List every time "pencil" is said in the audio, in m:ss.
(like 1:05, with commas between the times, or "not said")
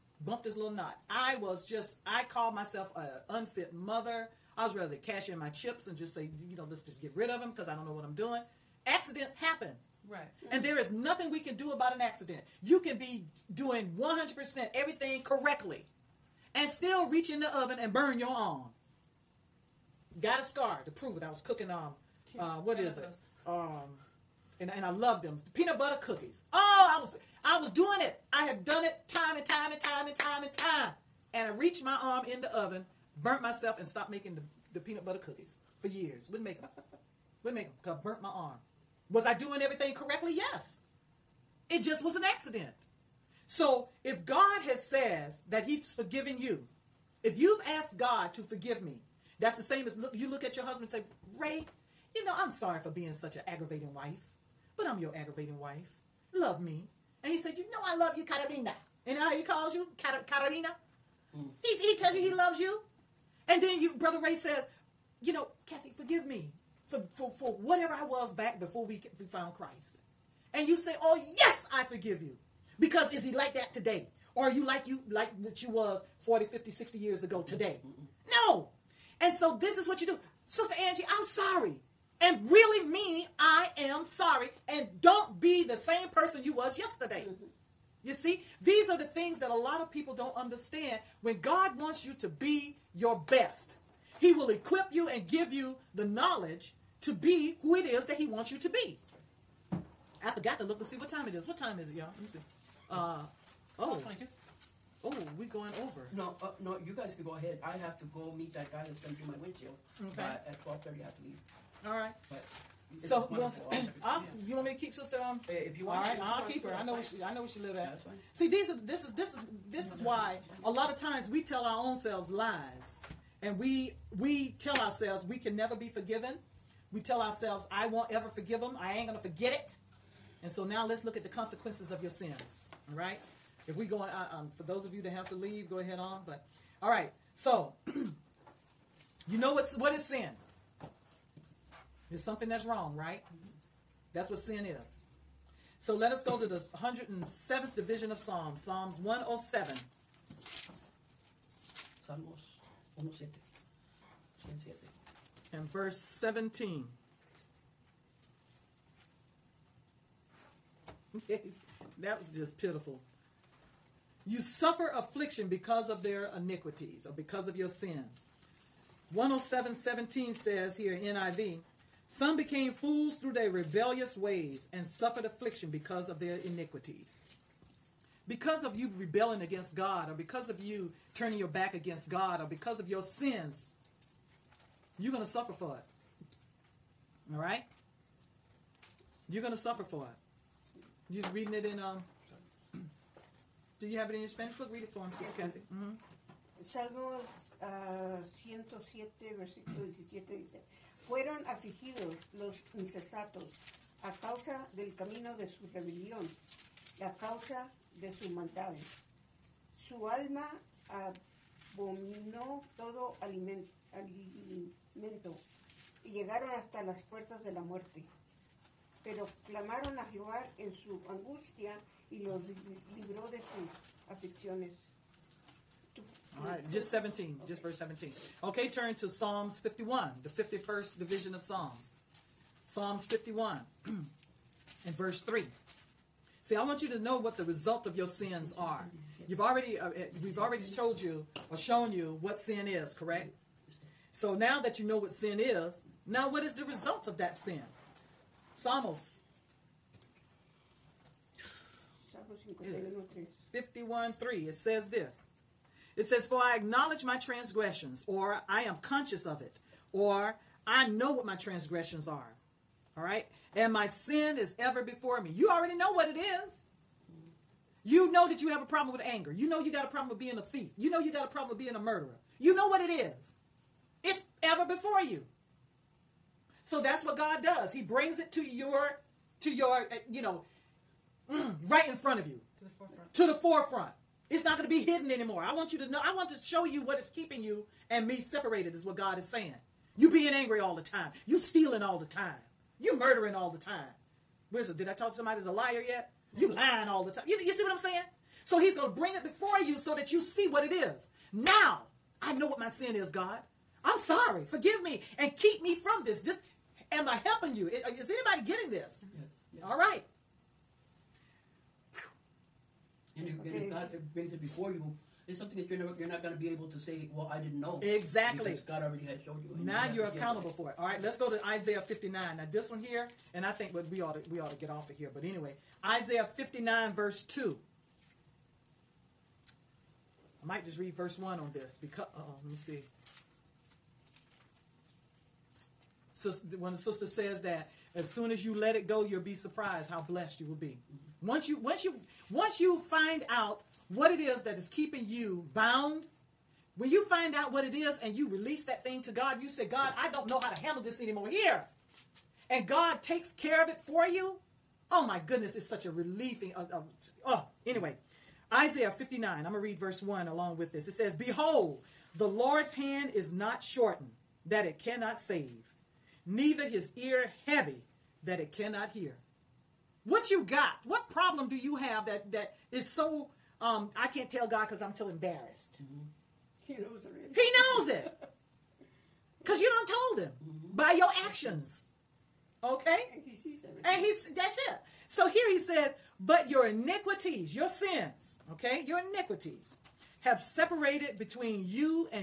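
not said.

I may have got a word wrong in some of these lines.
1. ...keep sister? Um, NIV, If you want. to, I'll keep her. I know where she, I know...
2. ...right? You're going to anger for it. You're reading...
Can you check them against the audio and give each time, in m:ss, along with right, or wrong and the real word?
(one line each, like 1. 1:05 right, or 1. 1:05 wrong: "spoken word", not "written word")
1. 1:54 wrong: "Yeah", not "NIV"
2. 3:07 wrong: "suffer", not "anger".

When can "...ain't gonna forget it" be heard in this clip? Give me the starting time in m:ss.
2:08.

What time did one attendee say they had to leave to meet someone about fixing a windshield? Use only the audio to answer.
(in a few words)
12:30.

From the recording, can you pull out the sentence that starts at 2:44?
You suffer affliction because of their iniquities or because of your sin.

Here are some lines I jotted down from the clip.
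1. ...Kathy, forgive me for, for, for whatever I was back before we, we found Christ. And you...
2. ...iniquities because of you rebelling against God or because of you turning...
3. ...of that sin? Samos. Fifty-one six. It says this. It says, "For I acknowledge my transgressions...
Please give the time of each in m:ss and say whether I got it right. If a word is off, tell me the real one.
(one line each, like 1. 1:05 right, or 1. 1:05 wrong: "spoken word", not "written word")
1. 1:05 right
2. 2:56 right
3. 4:07 wrong: "three", not "six".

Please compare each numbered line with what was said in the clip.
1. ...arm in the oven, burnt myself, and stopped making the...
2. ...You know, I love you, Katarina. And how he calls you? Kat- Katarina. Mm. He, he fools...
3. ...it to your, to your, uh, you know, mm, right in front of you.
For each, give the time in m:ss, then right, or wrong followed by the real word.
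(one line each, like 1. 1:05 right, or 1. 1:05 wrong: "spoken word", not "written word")
1. 0:32 right
2. 0:57 wrong: "tells", not "fools"
3. 4:38 right.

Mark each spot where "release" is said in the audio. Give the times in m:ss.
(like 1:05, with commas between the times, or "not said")
5:48.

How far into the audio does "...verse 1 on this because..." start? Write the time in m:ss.
5:30.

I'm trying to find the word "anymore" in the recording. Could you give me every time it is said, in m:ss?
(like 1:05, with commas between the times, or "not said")
4:45, 5:50.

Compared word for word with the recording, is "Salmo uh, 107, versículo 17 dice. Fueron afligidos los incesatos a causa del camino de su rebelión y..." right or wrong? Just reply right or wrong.
right.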